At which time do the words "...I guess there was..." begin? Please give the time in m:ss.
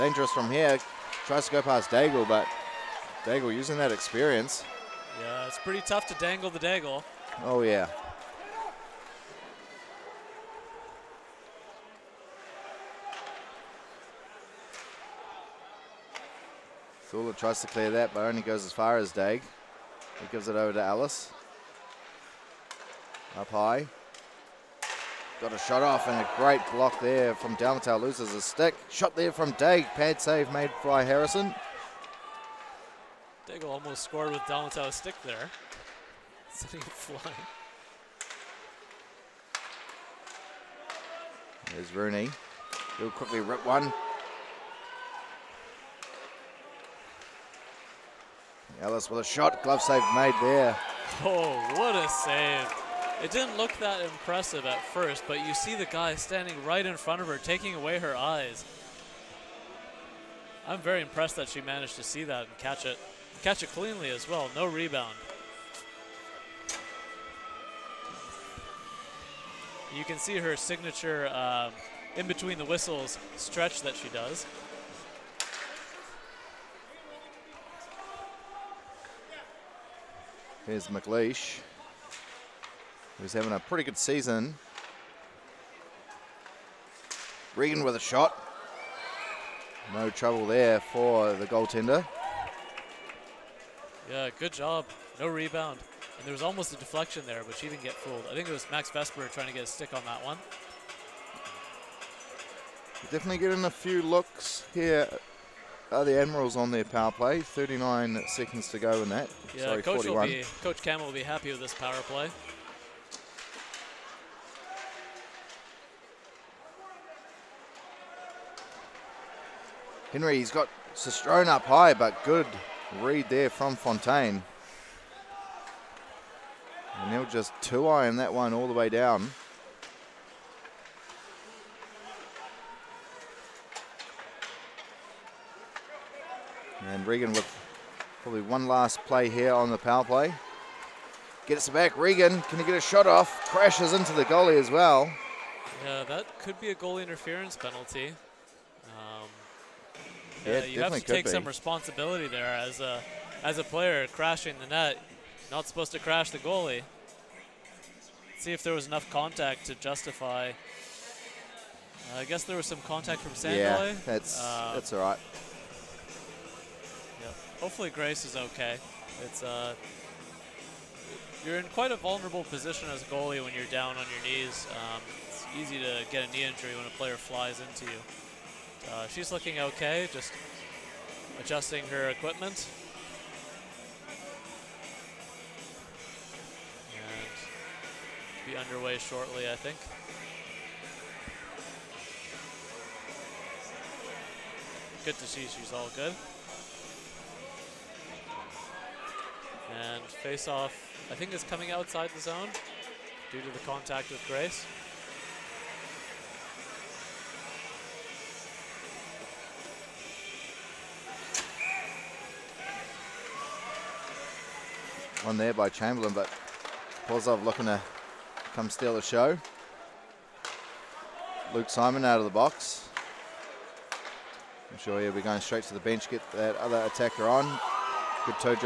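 2:42.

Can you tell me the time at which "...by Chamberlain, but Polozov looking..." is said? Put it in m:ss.
3:35.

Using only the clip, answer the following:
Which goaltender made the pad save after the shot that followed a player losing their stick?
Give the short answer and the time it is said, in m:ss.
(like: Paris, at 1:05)
Harrison, at 0:31.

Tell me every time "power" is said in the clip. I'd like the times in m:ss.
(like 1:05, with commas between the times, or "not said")
1:46, 1:51, 2:19.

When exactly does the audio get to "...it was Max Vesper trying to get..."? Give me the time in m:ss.
1:38.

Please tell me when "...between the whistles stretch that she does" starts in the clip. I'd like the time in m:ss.
1:12.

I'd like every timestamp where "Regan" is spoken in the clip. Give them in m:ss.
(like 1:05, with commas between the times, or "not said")
1:27, 2:17, 2:21.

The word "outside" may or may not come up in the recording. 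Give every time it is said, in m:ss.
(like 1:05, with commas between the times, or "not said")
3:21.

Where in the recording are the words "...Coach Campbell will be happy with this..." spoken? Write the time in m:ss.
1:50.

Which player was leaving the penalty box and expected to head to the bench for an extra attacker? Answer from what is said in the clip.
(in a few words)
Luke Simon.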